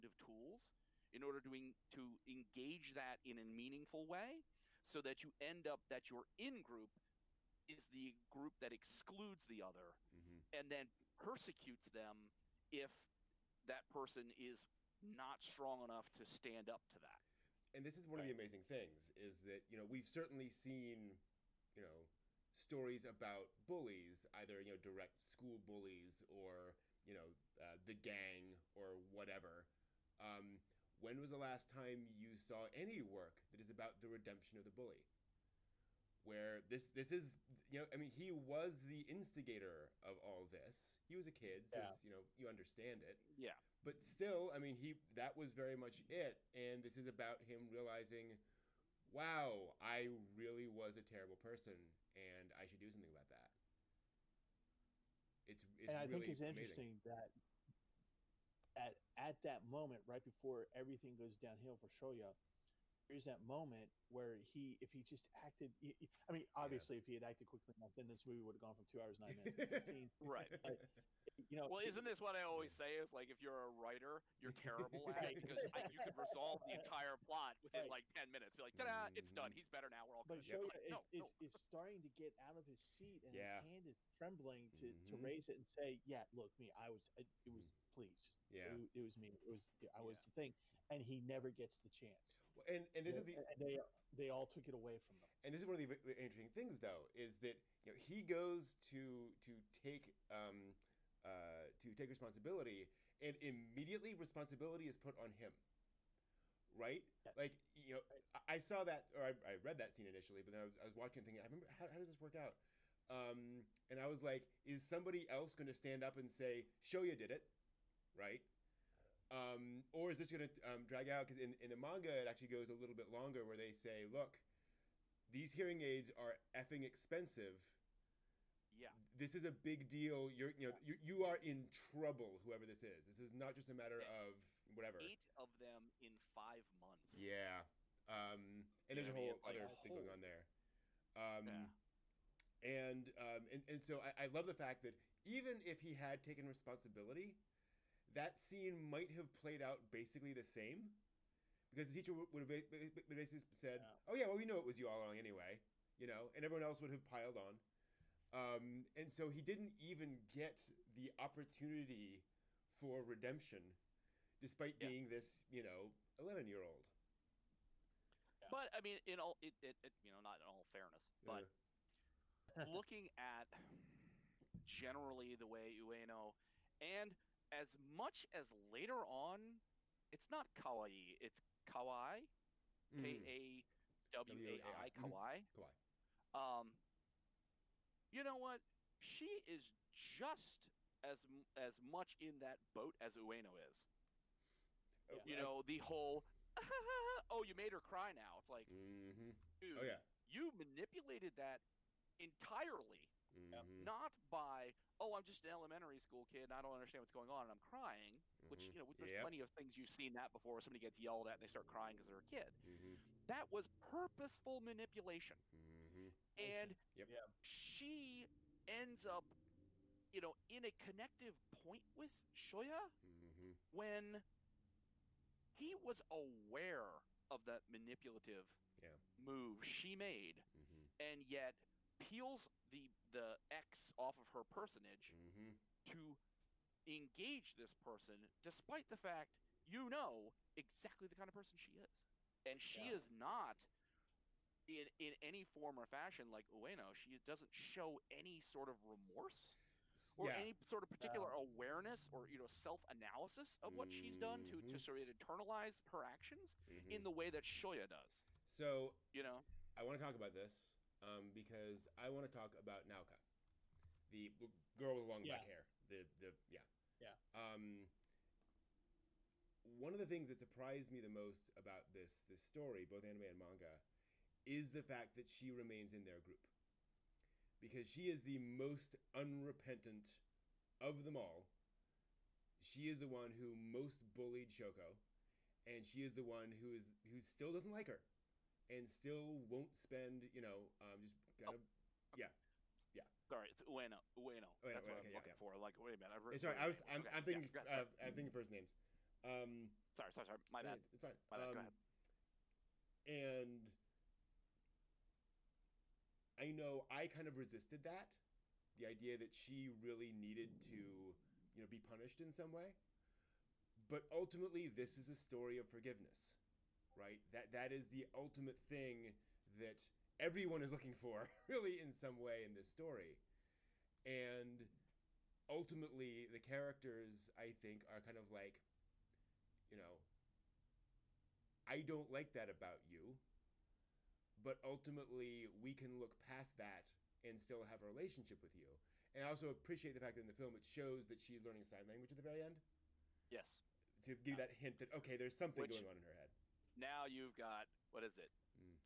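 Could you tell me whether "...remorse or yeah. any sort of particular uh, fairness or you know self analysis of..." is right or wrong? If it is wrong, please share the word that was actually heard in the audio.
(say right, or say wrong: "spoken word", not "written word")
wrong: "awareness", not "fairness".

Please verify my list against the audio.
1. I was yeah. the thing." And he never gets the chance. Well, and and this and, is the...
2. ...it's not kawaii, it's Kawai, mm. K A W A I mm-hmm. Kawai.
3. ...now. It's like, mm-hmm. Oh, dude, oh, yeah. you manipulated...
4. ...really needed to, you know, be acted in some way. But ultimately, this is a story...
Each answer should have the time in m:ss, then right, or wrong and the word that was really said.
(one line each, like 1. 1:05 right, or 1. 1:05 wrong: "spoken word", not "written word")
1. 1:29 right
2. 3:00 right
3. 3:18 right
4. 5:09 wrong: "punished", not "acted".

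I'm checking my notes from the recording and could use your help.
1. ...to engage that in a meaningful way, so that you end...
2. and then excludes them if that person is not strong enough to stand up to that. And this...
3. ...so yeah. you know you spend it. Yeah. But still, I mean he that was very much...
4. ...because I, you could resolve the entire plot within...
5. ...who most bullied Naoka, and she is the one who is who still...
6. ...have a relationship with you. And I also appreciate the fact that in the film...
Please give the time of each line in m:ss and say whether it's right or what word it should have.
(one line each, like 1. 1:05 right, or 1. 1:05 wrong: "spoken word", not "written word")
1. 0:01 right
2. 0:10 wrong: "persecutes", not "excludes"
3. 0:41 wrong: "understand", not "spend"
4. 1:15 right
5. 4:43 wrong: "Shoko", not "Naoka"
6. 5:37 right.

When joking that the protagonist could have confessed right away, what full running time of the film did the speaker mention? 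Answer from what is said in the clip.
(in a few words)
2 hours 9 minutes.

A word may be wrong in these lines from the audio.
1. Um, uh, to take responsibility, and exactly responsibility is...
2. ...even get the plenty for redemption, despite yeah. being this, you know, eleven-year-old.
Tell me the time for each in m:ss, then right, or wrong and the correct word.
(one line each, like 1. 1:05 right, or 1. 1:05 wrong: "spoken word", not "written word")
1. 1:40 wrong: "immediately", not "exactly"
2. 2:39 wrong: "opportunity", not "plenty".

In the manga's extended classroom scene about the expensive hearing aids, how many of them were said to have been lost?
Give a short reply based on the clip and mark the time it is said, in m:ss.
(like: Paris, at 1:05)
8, at 2:15.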